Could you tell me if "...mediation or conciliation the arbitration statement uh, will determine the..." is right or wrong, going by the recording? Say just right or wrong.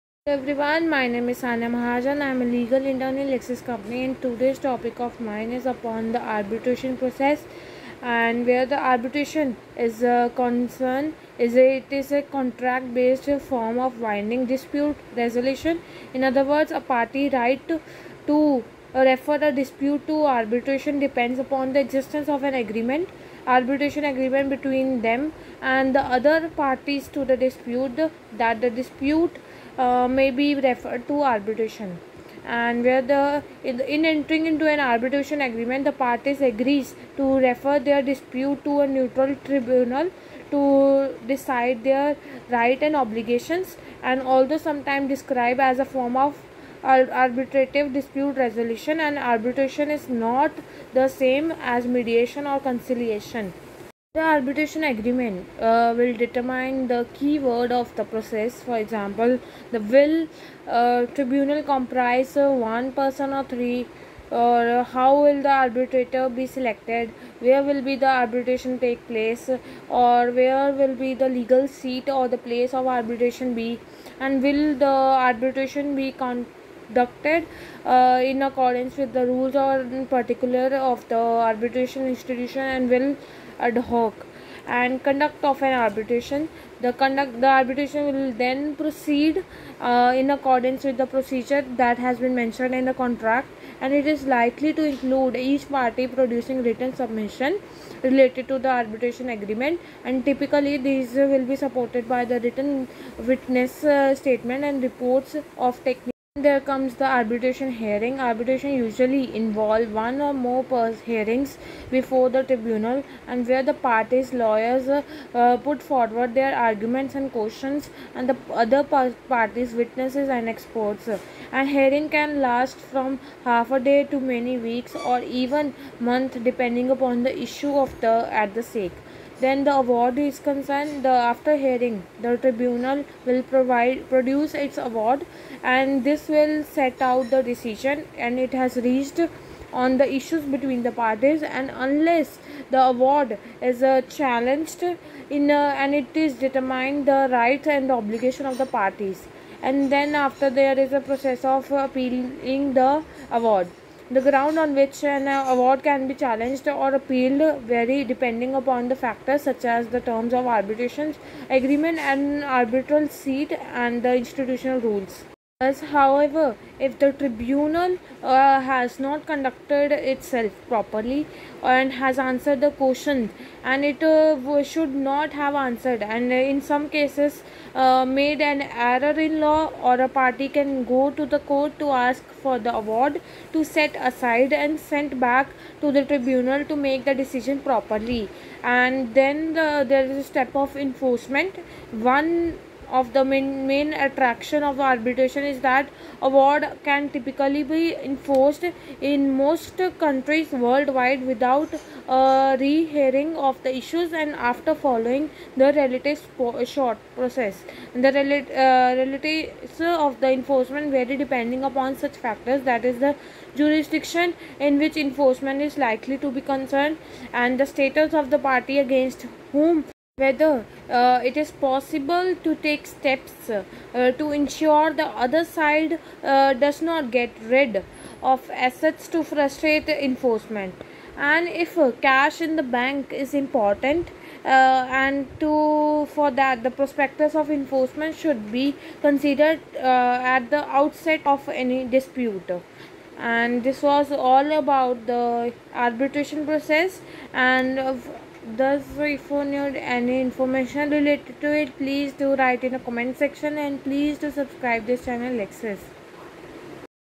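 wrong.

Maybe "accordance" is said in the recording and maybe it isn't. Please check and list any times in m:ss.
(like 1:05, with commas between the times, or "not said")
1:18, 1:30.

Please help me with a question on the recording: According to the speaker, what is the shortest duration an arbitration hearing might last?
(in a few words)
half a day.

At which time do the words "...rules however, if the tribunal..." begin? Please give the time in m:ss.
2:44.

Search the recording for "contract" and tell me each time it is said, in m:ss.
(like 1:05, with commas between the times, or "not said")
0:12, 1:32.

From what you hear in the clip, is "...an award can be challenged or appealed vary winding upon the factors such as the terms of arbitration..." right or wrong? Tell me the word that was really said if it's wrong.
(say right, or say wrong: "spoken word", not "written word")
wrong: "depending", not "winding".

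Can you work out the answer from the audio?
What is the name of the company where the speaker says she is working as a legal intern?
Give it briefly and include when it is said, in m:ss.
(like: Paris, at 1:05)
Lexis, at 0:03.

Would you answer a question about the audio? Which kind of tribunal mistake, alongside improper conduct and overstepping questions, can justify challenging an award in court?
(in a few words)
an error in law.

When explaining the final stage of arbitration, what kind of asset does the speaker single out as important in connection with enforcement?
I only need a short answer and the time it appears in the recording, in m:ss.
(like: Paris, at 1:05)
cash in the bank, at 3:52.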